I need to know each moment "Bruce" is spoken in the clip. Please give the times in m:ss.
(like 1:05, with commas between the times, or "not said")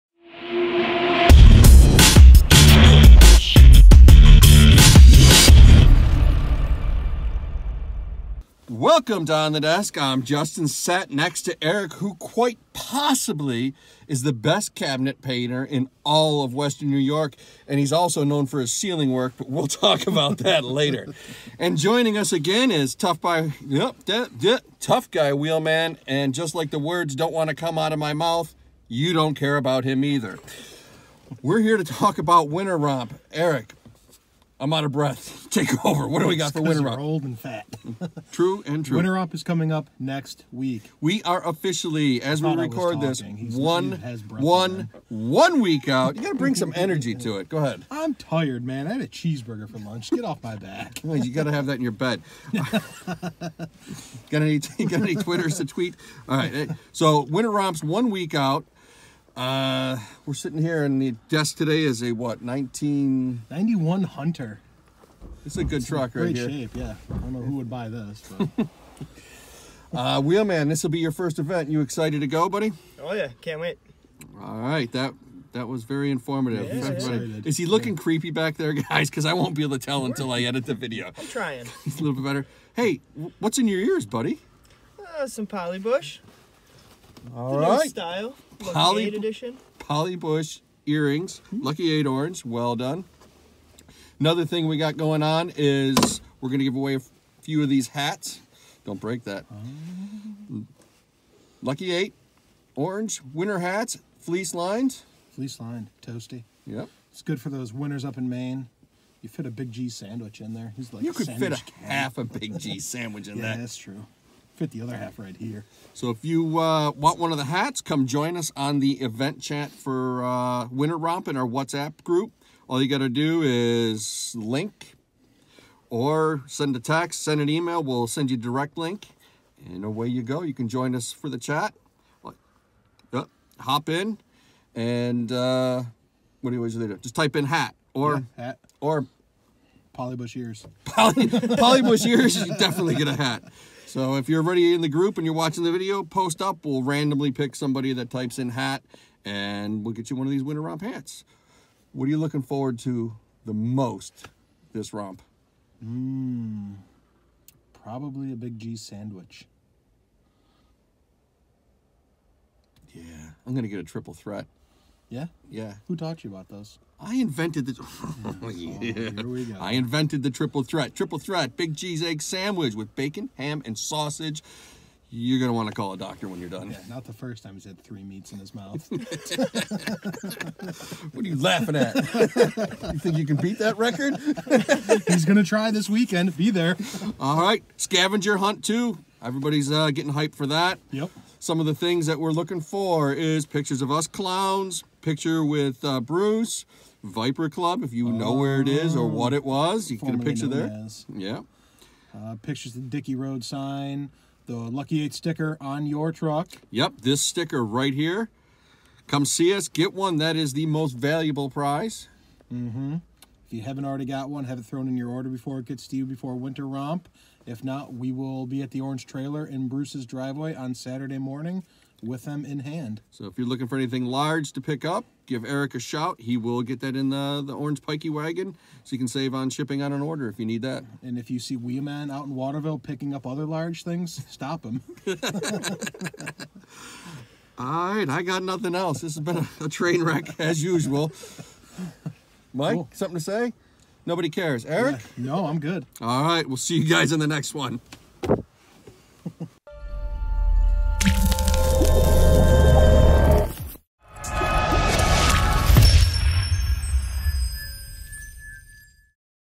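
3:15, 3:39.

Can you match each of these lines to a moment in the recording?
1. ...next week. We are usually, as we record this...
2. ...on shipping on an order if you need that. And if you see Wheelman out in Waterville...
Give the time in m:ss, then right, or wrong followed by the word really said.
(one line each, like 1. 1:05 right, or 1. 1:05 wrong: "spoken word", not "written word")
1. 0:39 wrong: "officially", not "usually"
2. 3:49 right.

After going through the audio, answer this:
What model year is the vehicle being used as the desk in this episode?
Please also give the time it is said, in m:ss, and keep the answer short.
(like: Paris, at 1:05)
1991, at 1:02.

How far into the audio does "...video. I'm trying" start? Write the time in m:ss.
1:20.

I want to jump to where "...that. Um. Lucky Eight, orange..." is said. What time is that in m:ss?
1:39.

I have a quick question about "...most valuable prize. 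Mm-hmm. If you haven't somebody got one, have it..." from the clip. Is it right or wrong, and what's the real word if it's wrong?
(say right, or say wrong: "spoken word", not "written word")
wrong: "already", not "somebody".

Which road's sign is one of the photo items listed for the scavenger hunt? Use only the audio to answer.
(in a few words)
Dickey Road.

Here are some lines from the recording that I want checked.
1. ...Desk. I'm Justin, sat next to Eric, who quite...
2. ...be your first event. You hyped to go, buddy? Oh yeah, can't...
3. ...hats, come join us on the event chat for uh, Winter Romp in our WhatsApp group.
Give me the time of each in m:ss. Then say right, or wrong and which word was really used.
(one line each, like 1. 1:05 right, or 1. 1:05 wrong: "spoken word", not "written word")
1. 0:09 right
2. 1:10 wrong: "excited", not "hyped"
3. 1:57 right.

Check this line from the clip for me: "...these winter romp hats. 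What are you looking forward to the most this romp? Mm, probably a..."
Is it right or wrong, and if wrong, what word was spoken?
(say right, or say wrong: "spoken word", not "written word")
right.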